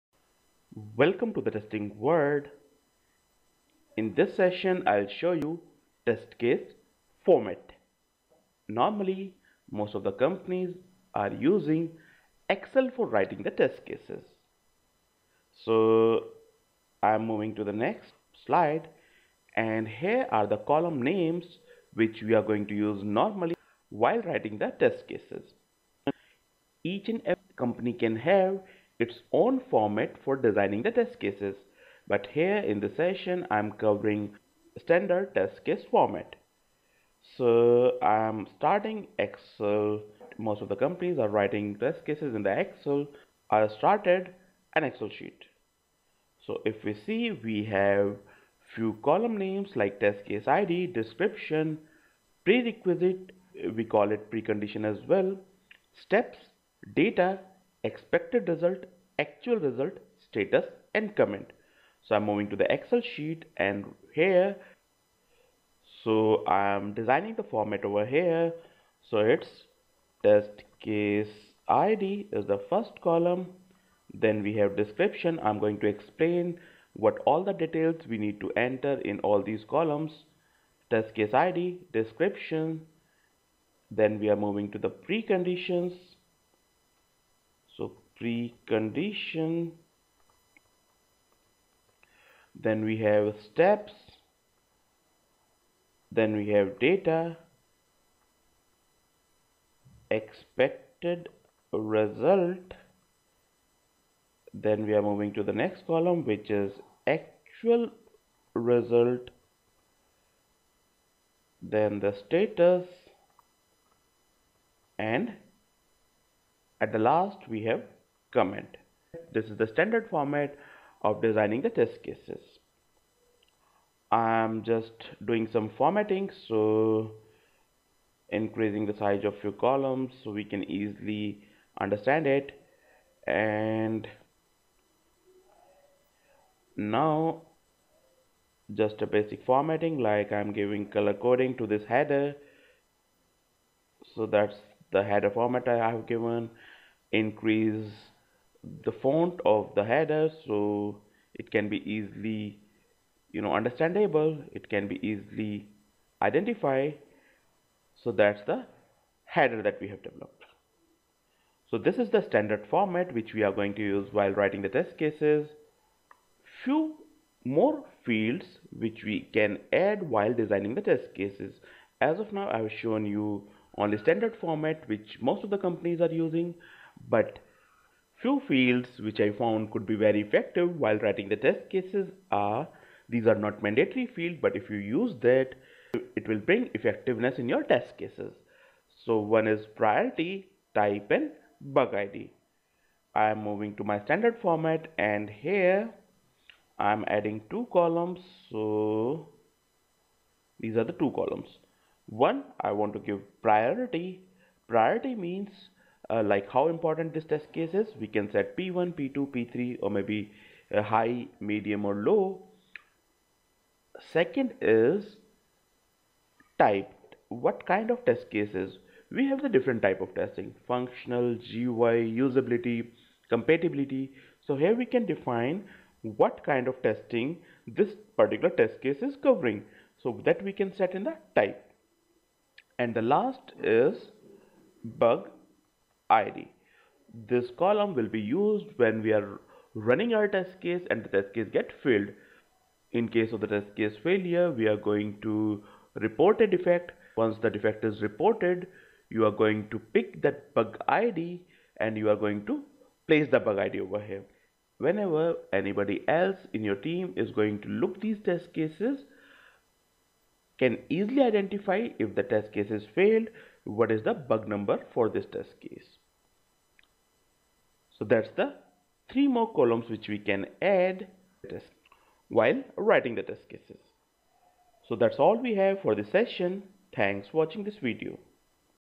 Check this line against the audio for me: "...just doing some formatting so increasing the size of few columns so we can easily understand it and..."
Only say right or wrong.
right.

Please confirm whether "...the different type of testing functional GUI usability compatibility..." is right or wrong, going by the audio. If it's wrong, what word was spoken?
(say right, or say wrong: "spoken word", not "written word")
right.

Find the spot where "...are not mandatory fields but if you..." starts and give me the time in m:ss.
3:03.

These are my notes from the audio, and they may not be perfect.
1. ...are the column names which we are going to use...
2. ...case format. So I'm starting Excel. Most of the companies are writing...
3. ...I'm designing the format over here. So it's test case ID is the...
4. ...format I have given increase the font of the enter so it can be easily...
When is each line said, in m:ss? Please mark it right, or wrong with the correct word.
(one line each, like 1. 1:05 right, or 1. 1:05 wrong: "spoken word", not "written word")
1. 0:20 right
2. 0:35 right
3. 1:06 right
4. 2:25 wrong: "header", not "enter".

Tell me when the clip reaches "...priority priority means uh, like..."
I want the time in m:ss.
3:23.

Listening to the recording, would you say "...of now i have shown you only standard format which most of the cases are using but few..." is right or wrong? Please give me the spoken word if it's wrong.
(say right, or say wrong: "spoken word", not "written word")
wrong: "companies", not "cases".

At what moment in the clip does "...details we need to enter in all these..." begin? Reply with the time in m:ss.
1:17.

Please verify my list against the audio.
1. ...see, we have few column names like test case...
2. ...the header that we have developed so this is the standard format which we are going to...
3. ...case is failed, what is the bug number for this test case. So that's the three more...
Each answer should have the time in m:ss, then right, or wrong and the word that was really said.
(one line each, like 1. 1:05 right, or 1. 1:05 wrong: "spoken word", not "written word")
1. 0:46 right
2. 2:38 right
3. 4:22 right.